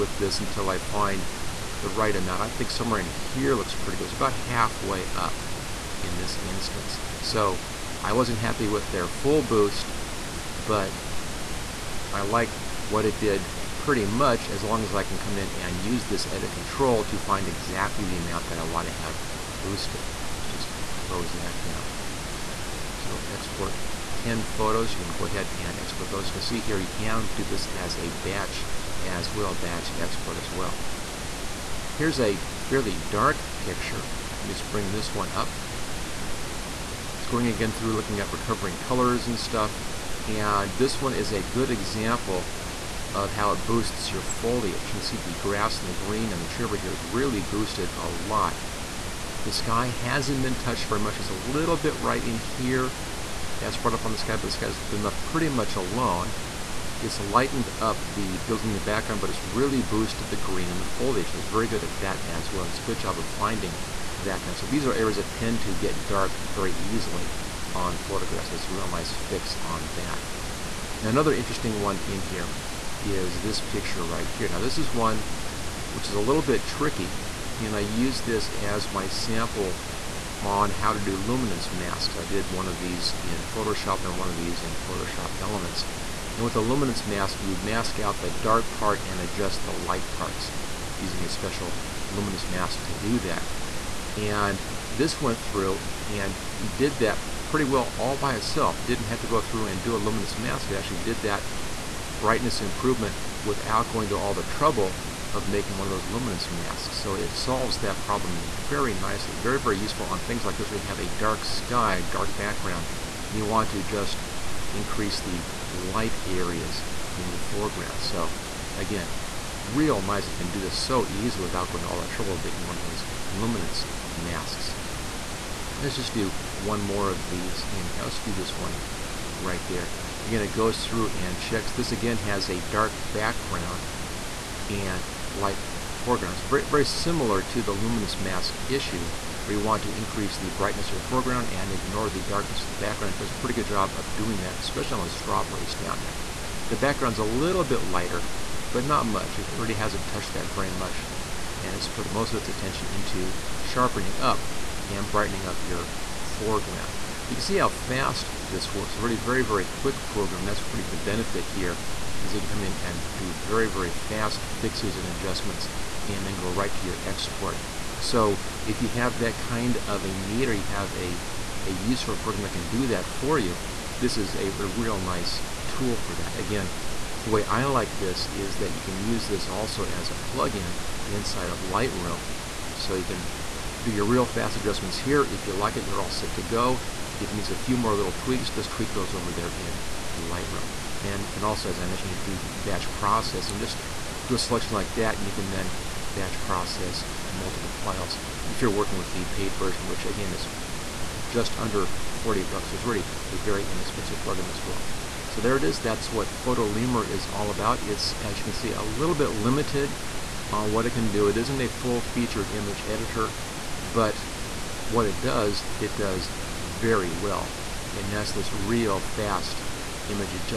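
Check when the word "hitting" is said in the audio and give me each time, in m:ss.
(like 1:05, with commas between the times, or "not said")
not said.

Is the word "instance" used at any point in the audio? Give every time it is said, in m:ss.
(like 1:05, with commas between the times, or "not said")
0:06.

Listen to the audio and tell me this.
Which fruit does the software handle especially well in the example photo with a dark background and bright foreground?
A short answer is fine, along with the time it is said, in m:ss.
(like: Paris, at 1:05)
Strawberries, at 2:25.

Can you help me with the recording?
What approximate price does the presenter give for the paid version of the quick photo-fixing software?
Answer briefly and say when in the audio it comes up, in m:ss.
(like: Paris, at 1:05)
Just under $40, at 3:21.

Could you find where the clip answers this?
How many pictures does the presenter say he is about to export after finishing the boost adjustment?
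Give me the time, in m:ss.
0:24.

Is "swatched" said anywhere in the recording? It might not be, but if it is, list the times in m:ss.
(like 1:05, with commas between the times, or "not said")
not said.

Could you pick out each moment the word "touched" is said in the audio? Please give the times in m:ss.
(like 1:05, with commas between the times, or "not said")
0:50, 2:30.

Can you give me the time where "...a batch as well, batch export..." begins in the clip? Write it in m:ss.
0:27.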